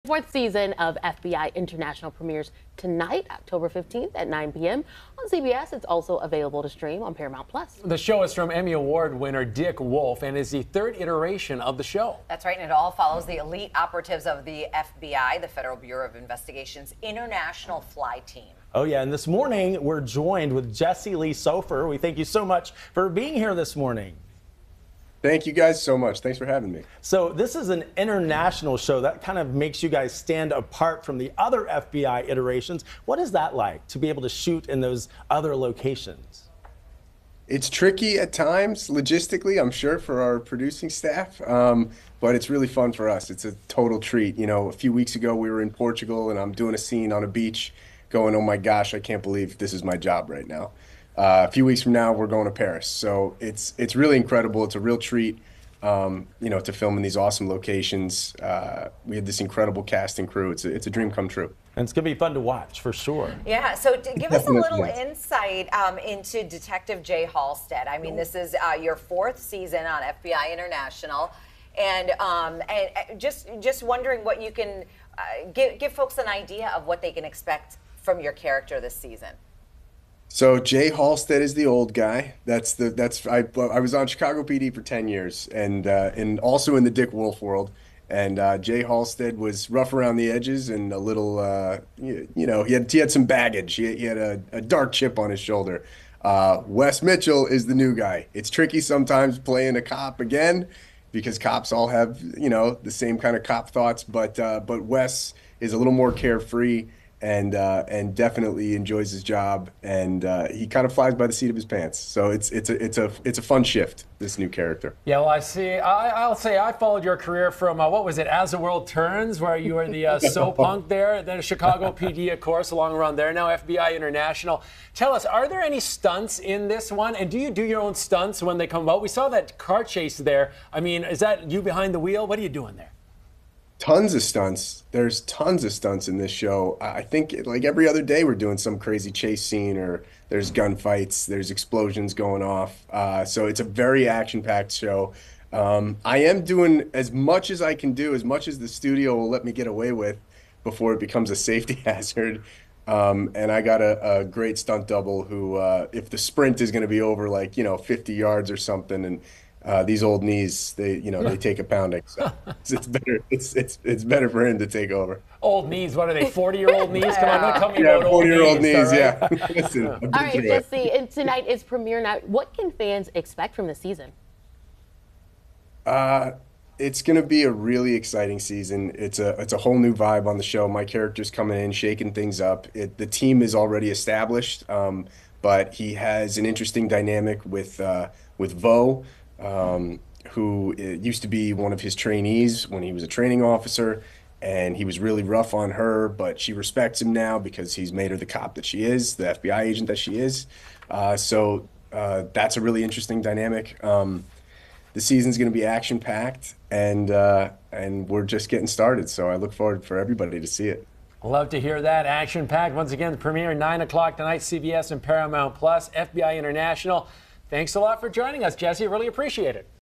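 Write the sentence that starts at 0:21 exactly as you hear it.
We thank you so much for being here this morning.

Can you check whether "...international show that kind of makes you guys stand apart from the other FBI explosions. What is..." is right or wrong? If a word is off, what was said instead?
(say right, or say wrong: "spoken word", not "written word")
wrong: "iterations", not "explosions".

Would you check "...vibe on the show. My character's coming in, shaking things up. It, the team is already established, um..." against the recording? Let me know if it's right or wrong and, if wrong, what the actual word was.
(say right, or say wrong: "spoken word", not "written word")
right.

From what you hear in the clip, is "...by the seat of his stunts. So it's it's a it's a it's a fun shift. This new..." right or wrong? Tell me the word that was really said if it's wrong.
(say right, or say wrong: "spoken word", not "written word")
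wrong: "pants", not "stunts".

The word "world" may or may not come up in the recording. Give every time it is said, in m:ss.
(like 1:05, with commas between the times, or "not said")
1:27, 1:58.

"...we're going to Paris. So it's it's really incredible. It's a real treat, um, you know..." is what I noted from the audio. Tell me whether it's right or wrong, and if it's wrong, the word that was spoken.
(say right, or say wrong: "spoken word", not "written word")
right.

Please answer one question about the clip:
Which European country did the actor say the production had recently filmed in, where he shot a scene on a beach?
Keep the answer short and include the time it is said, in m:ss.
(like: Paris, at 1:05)
Portugal, at 0:45.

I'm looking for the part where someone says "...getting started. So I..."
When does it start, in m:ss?
3:28.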